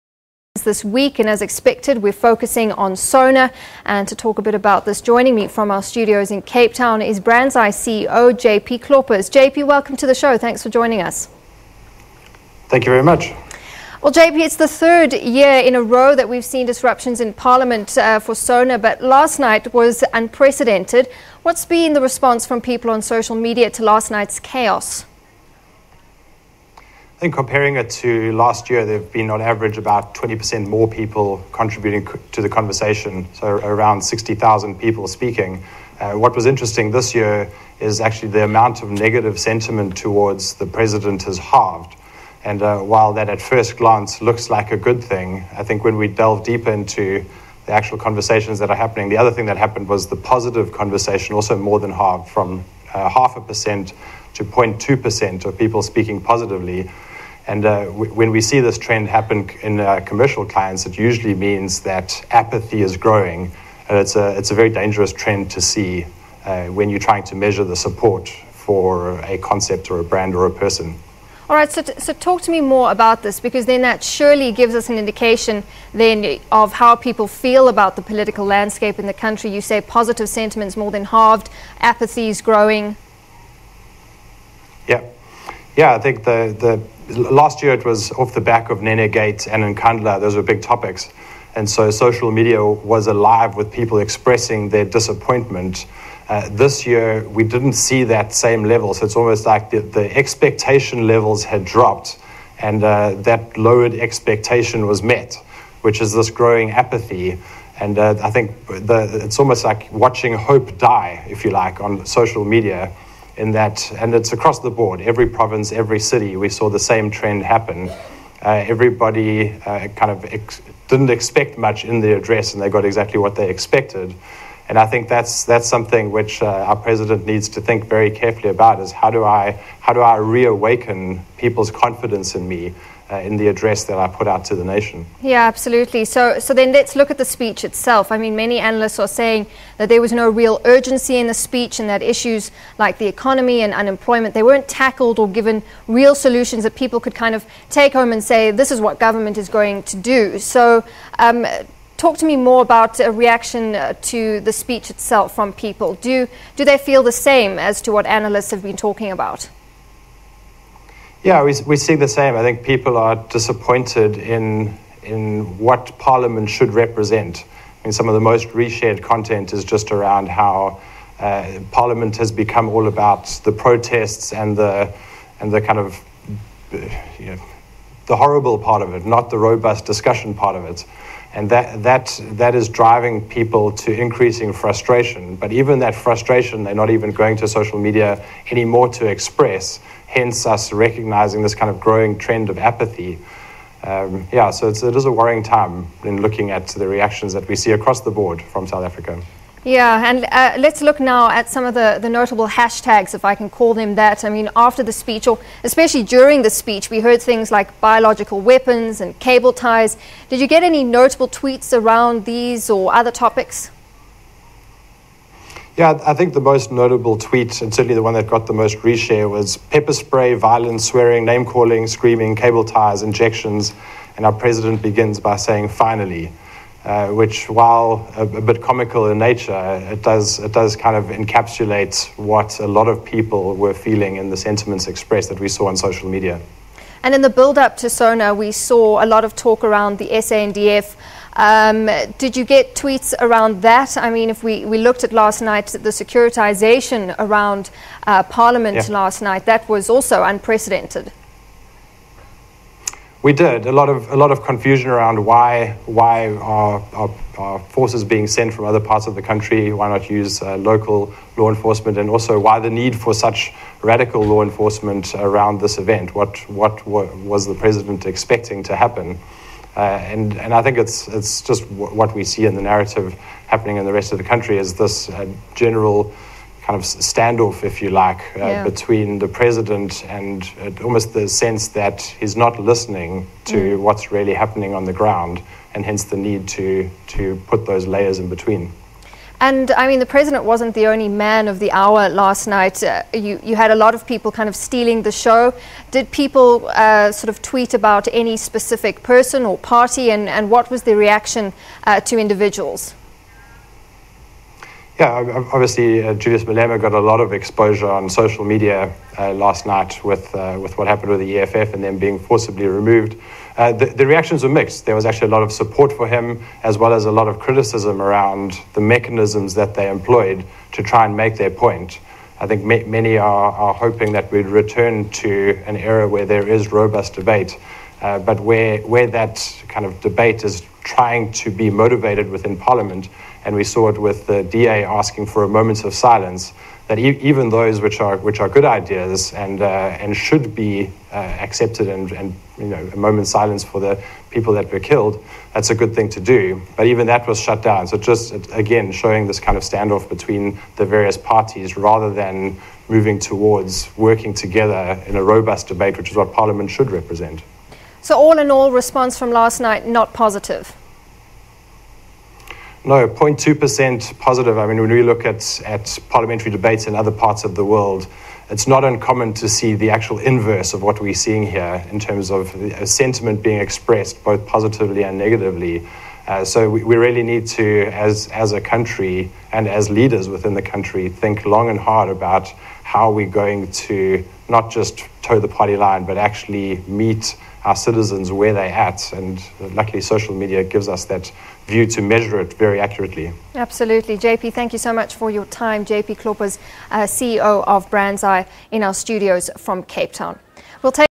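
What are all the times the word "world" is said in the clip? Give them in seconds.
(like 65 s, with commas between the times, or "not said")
367 s.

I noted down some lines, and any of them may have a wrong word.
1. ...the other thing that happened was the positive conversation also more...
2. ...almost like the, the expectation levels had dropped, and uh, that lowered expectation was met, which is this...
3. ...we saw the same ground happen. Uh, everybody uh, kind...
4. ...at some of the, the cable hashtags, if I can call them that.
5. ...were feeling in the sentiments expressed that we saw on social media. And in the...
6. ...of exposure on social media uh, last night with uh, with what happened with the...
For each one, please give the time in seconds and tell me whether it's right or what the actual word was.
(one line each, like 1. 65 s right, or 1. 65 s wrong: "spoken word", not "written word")
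1. 49 s right
2. 99 s right
3. 116 s wrong: "trend", not "ground"
4. 201 s wrong: "notable", not "cable"
5. 233 s right
6. 307 s right.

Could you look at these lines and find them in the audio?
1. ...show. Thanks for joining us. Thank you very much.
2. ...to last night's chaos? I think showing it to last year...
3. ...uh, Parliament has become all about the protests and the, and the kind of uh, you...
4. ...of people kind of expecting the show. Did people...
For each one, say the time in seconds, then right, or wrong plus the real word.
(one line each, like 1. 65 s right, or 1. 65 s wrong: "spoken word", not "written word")
1. 10 s right
2. 23 s wrong: "comparing", not "showing"
3. 171 s right
4. 293 s wrong: "stealing", not "expecting".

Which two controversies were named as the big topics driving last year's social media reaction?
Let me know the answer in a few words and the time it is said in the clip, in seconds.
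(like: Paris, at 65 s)
Gates and Nkandla, at 88 s.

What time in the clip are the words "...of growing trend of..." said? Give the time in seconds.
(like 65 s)
191 s.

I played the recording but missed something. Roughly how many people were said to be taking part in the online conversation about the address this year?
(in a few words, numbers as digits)
60,000.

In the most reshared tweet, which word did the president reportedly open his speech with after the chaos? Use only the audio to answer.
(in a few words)
Finally.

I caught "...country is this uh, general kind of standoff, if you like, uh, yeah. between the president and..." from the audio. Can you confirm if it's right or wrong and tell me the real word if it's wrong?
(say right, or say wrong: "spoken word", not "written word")
right.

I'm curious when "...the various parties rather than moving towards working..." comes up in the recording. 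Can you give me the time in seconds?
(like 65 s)
350 s.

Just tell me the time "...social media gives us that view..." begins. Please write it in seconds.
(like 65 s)
390 s.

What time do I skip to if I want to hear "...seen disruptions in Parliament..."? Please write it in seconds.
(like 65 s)
16 s.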